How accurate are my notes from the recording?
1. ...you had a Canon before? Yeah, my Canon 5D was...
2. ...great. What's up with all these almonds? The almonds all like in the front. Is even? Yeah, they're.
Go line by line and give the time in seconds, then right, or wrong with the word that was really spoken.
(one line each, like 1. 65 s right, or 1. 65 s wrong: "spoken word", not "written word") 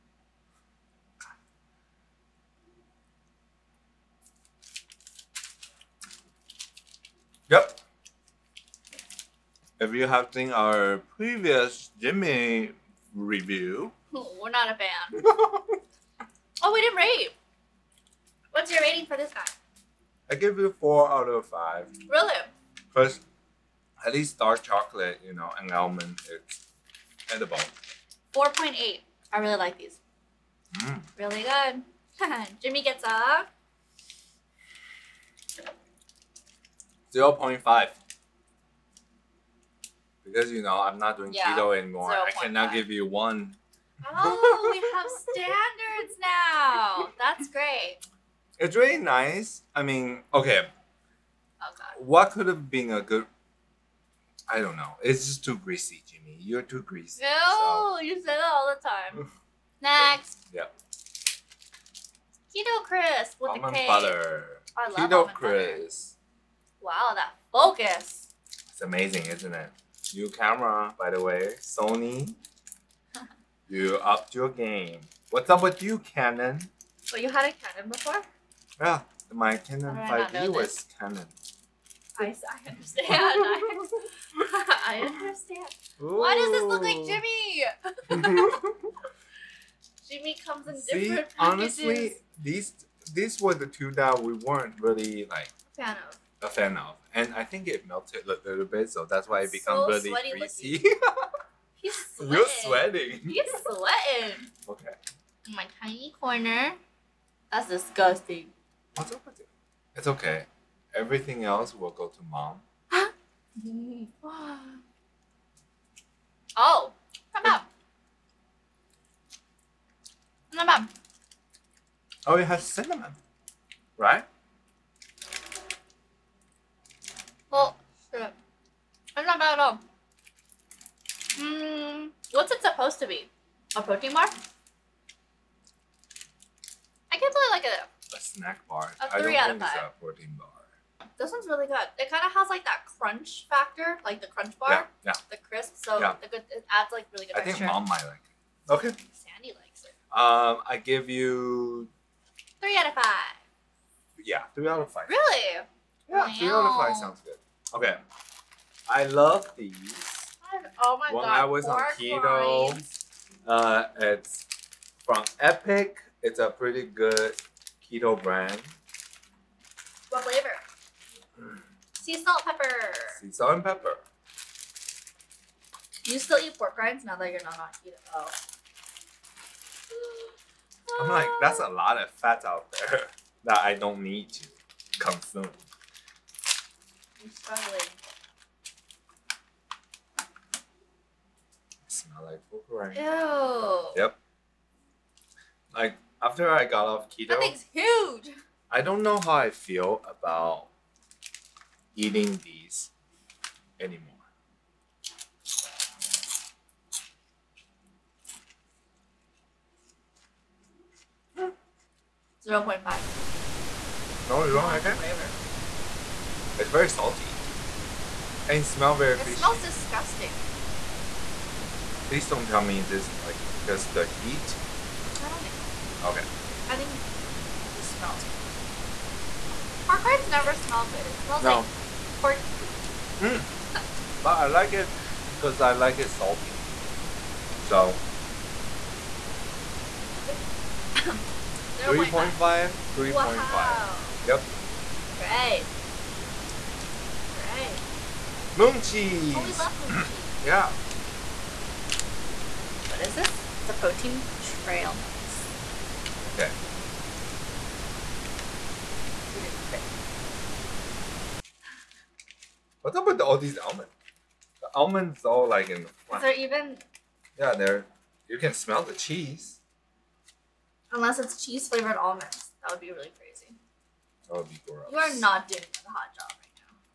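1. 77 s right
2. 259 s right.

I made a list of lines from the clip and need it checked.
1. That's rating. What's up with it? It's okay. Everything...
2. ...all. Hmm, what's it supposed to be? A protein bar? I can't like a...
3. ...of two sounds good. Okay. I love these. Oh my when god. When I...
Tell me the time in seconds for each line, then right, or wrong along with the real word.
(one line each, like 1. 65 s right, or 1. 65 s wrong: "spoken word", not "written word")
1. 107 s wrong: "disgusting", not "rating"
2. 129 s right
3. 156 s wrong: "five", not "two".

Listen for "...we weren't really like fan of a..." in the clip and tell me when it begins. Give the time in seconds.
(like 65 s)
94 s.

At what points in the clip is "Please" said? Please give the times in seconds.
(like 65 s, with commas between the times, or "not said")
222 s.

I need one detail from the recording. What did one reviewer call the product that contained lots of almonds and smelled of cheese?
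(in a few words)
protein trail mix.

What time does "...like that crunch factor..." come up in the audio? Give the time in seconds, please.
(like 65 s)
142 s.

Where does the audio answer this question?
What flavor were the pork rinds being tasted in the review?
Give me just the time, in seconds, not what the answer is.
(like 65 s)
173 s.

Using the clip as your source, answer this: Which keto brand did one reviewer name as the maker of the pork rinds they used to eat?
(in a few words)
Epic.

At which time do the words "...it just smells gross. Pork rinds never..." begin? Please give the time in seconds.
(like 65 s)
227 s.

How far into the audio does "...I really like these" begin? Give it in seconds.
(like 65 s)
29 s.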